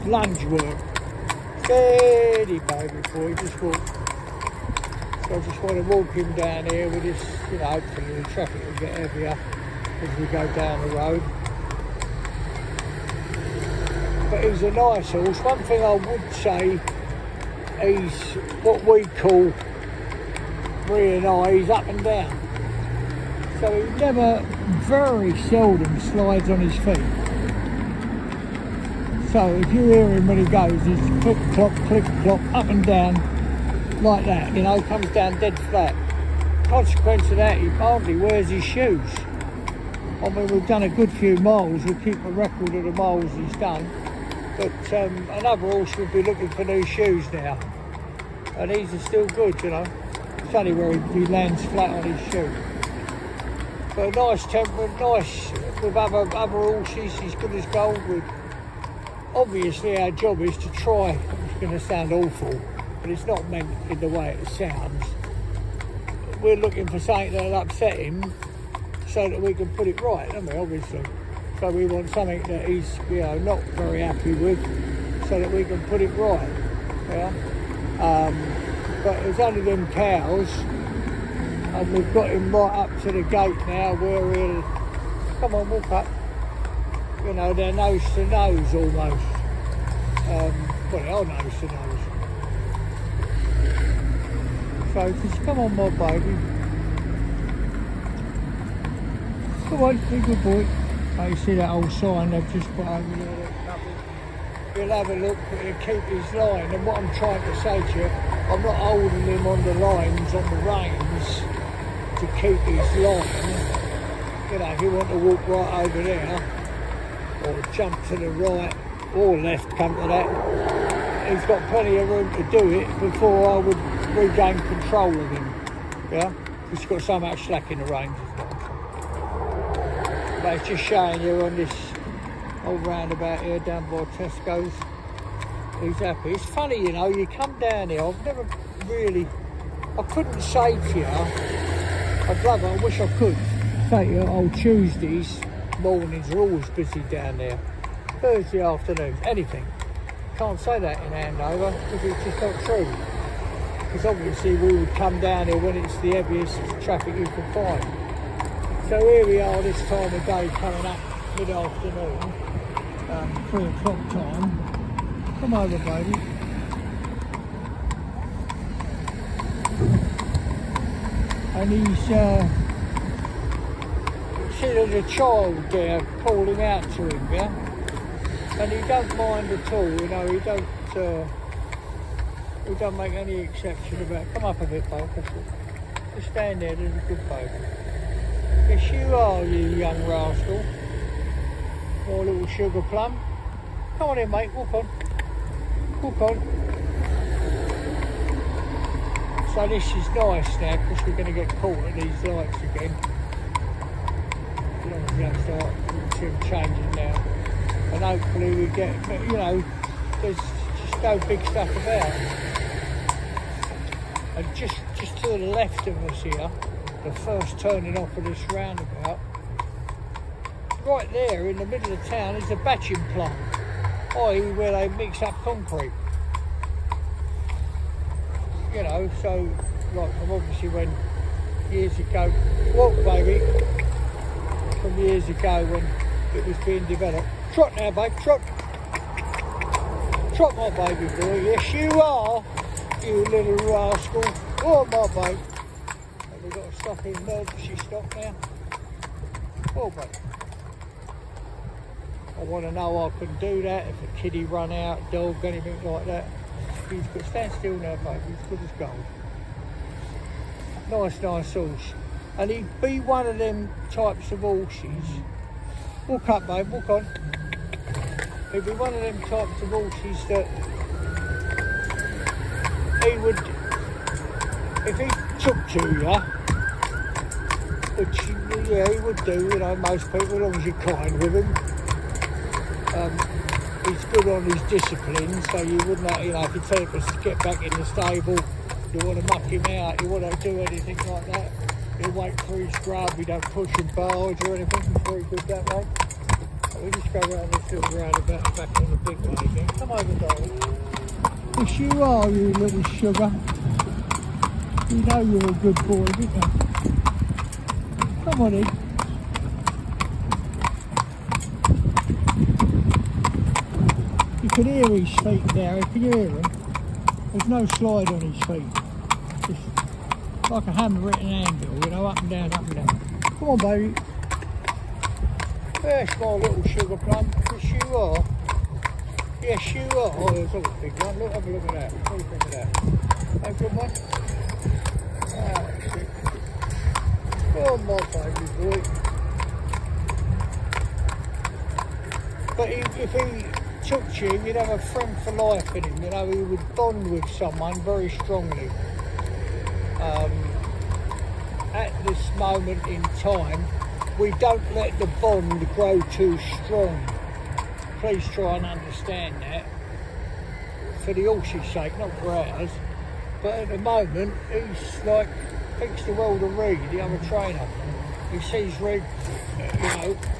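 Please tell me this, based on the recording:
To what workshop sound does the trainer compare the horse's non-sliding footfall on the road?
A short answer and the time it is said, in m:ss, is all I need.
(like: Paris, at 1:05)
hammer at an anvil, at 5:20.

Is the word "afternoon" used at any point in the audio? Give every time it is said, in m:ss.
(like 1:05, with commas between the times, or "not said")
2:28, 2:41.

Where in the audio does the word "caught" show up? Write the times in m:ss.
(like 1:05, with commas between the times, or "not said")
3:21.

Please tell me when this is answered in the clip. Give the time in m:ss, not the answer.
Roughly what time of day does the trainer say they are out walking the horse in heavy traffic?
2:43.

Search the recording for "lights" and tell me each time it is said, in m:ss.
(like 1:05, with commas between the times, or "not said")
3:22.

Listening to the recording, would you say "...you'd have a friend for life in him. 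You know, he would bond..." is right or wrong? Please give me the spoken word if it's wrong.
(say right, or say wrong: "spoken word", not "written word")
right.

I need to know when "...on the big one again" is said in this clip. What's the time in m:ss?
4:58.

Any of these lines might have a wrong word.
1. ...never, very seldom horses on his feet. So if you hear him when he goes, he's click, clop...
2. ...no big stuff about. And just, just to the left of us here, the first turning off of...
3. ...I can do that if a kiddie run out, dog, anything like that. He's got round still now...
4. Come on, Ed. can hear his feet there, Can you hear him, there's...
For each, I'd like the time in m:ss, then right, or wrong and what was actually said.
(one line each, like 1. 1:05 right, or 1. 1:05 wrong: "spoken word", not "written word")
1. 0:23 wrong: "slides", not "horses"
2. 3:31 right
3. 4:13 wrong: "stand", not "round"
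4. 5:08 right.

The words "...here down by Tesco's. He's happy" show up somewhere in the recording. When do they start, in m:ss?
2:13.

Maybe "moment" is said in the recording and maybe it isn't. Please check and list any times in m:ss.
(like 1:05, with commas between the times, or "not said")
5:52, 6:03.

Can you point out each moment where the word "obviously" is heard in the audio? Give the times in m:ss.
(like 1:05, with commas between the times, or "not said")
0:59, 1:10, 2:34, 3:50.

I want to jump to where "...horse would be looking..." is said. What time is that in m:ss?
0:45.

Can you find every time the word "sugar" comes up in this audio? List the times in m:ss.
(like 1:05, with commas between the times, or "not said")
3:12, 5:02, 5:26.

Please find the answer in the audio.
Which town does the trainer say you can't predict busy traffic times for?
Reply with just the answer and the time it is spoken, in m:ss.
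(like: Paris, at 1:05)
Andover, at 2:31.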